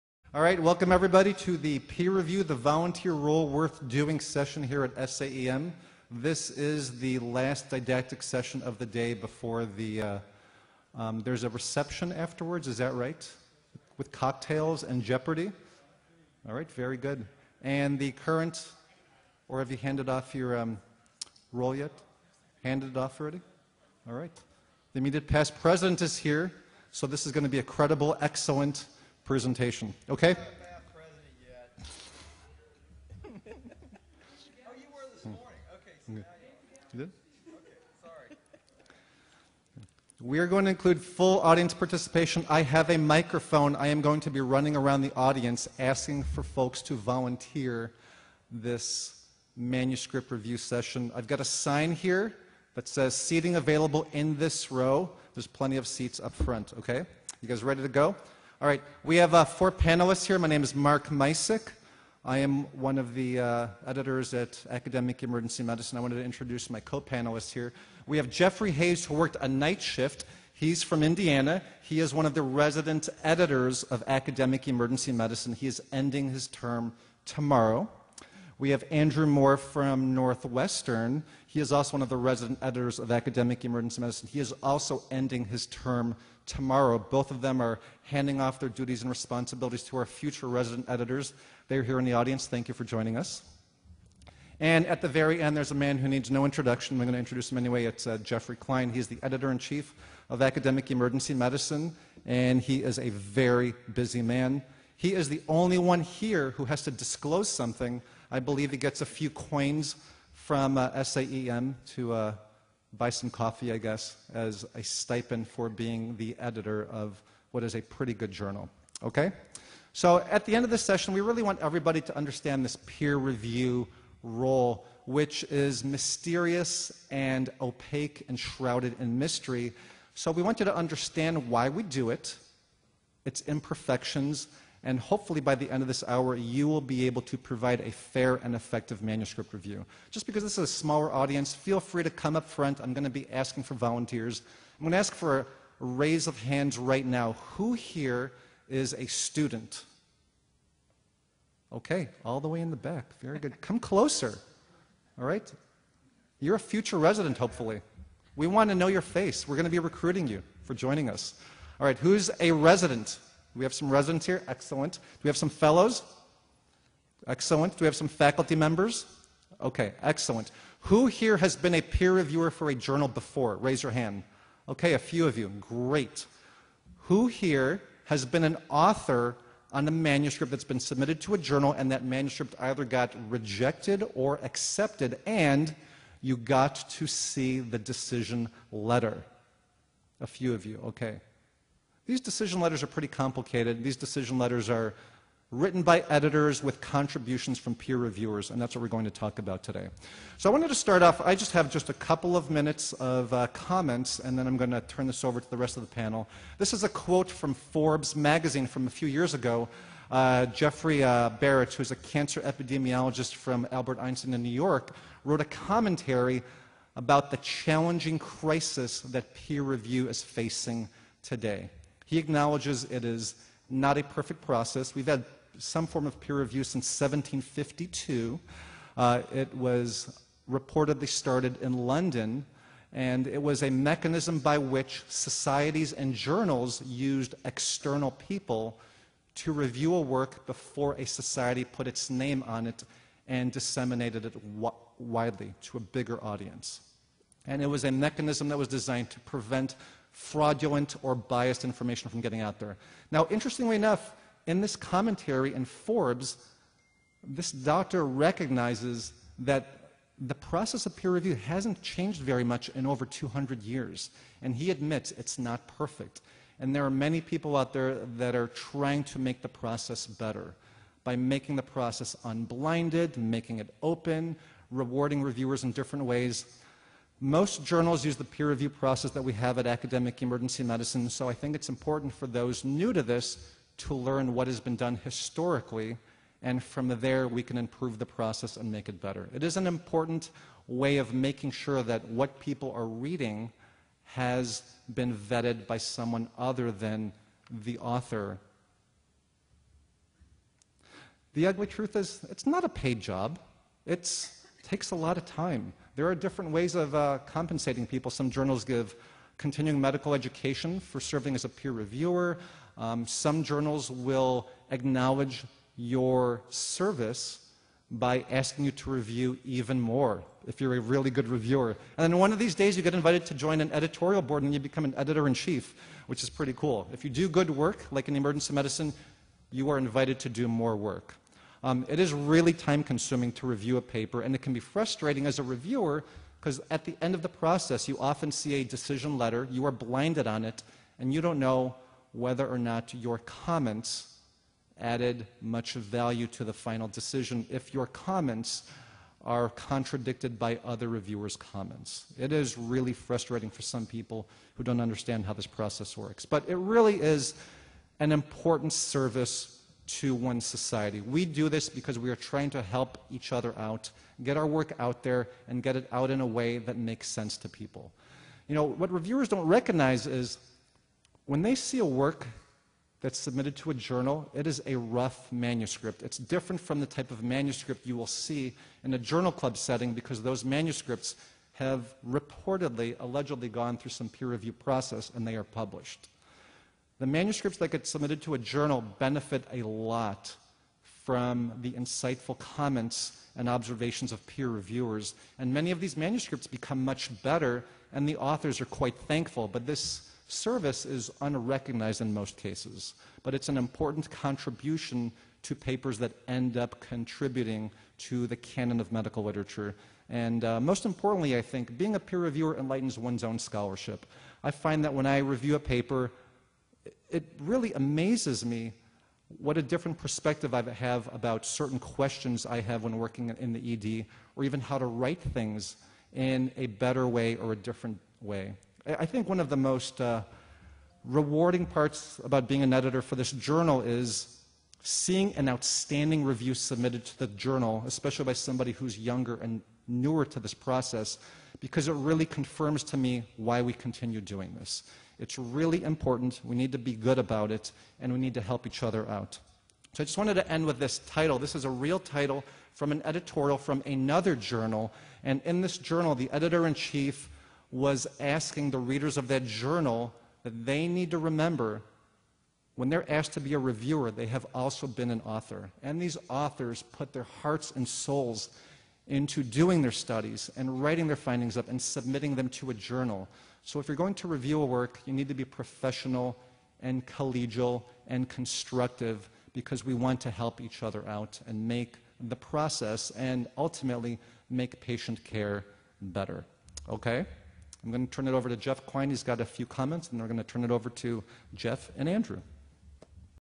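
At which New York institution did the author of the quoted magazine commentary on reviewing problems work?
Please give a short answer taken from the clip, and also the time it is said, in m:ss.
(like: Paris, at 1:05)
Albert Einstein, at 3:33.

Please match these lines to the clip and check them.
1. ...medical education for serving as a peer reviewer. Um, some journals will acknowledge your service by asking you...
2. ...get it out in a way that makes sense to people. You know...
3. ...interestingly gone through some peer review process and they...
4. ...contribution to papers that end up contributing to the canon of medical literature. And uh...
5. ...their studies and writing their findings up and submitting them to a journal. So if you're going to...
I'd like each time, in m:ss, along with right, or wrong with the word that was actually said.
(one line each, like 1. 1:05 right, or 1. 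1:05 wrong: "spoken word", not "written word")
1. 5:09 right
2. 6:05 right
3. 6:22 wrong: "allegedly", not "interestingly"
4. 6:44 right
5. 7:49 right.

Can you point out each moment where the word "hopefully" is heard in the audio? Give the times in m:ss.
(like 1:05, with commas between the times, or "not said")
2:14, 2:37.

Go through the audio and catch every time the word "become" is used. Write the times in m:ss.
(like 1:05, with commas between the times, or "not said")
5:24, 6:36.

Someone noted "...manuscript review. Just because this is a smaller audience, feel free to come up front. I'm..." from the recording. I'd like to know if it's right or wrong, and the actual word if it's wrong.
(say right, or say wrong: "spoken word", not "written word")
right.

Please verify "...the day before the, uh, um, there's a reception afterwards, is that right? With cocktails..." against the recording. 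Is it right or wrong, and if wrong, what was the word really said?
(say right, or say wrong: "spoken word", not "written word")
right.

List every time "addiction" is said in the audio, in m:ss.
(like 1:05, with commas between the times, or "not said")
not said.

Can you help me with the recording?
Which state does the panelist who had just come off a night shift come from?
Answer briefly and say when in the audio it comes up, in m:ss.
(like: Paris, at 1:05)
Indiana, at 1:11.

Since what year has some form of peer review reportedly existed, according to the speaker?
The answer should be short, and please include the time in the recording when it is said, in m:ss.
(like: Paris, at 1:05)
1752, at 3:46.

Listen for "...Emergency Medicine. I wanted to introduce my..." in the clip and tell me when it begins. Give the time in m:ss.
1:05.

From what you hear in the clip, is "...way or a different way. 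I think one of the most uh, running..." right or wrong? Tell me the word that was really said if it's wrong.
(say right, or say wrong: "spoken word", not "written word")
wrong: "rewarding", not "running".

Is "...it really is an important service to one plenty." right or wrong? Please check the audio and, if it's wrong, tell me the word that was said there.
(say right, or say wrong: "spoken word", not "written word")
wrong: "society", not "plenty".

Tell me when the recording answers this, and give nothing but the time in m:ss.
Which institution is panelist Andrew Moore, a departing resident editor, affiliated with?
1:20.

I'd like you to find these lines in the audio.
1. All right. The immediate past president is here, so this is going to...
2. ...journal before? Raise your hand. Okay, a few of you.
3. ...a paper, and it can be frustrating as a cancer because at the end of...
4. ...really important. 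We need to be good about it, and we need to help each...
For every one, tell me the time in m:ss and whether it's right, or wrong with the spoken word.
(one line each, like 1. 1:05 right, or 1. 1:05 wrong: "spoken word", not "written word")
1. 0:24 right
2. 2:52 right
3. 5:33 wrong: "reviewer", not "cancer"
4. 7:25 right.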